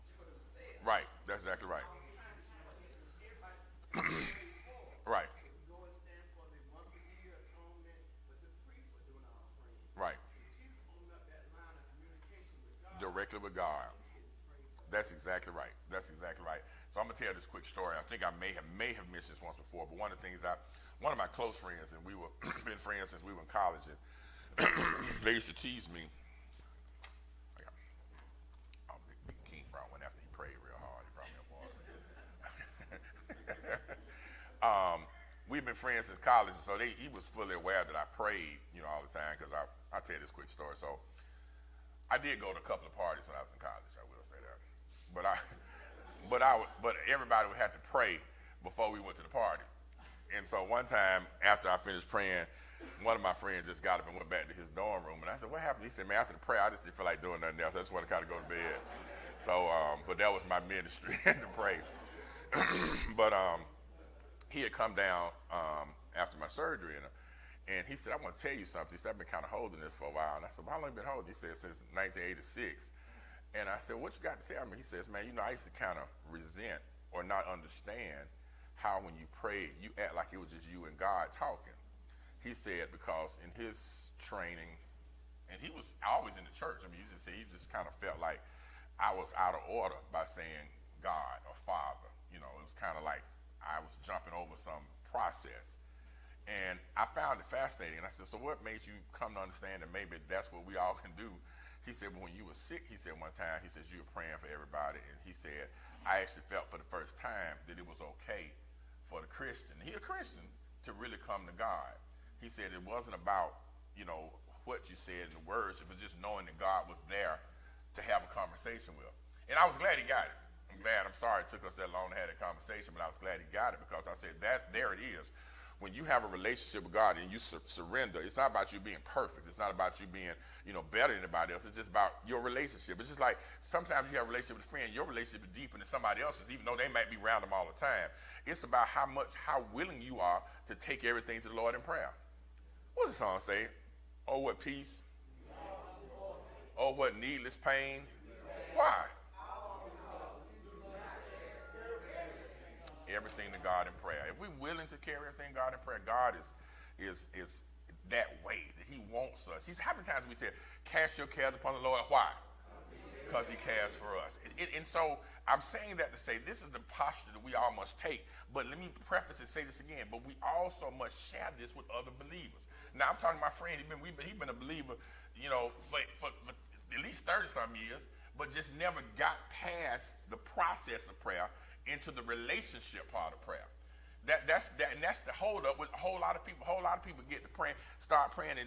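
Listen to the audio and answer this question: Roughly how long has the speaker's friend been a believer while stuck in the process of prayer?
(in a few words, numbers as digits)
thirty some years.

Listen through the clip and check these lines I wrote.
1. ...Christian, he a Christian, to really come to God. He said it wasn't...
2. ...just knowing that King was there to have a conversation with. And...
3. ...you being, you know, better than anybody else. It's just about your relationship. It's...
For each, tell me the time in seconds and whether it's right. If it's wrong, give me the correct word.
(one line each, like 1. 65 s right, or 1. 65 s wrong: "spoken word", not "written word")
1. 109 s right
2. 115 s wrong: "God", not "King"
3. 130 s right.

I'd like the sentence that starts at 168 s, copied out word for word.
But let me preface and say this again.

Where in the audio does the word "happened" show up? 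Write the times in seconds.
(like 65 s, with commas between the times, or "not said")
55 s.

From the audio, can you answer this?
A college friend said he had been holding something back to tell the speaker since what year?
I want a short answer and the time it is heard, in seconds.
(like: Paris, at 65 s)
1986, at 71 s.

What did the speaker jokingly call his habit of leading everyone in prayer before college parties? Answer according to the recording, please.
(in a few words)
my ministry.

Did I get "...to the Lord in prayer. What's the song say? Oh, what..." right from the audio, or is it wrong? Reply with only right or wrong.
right.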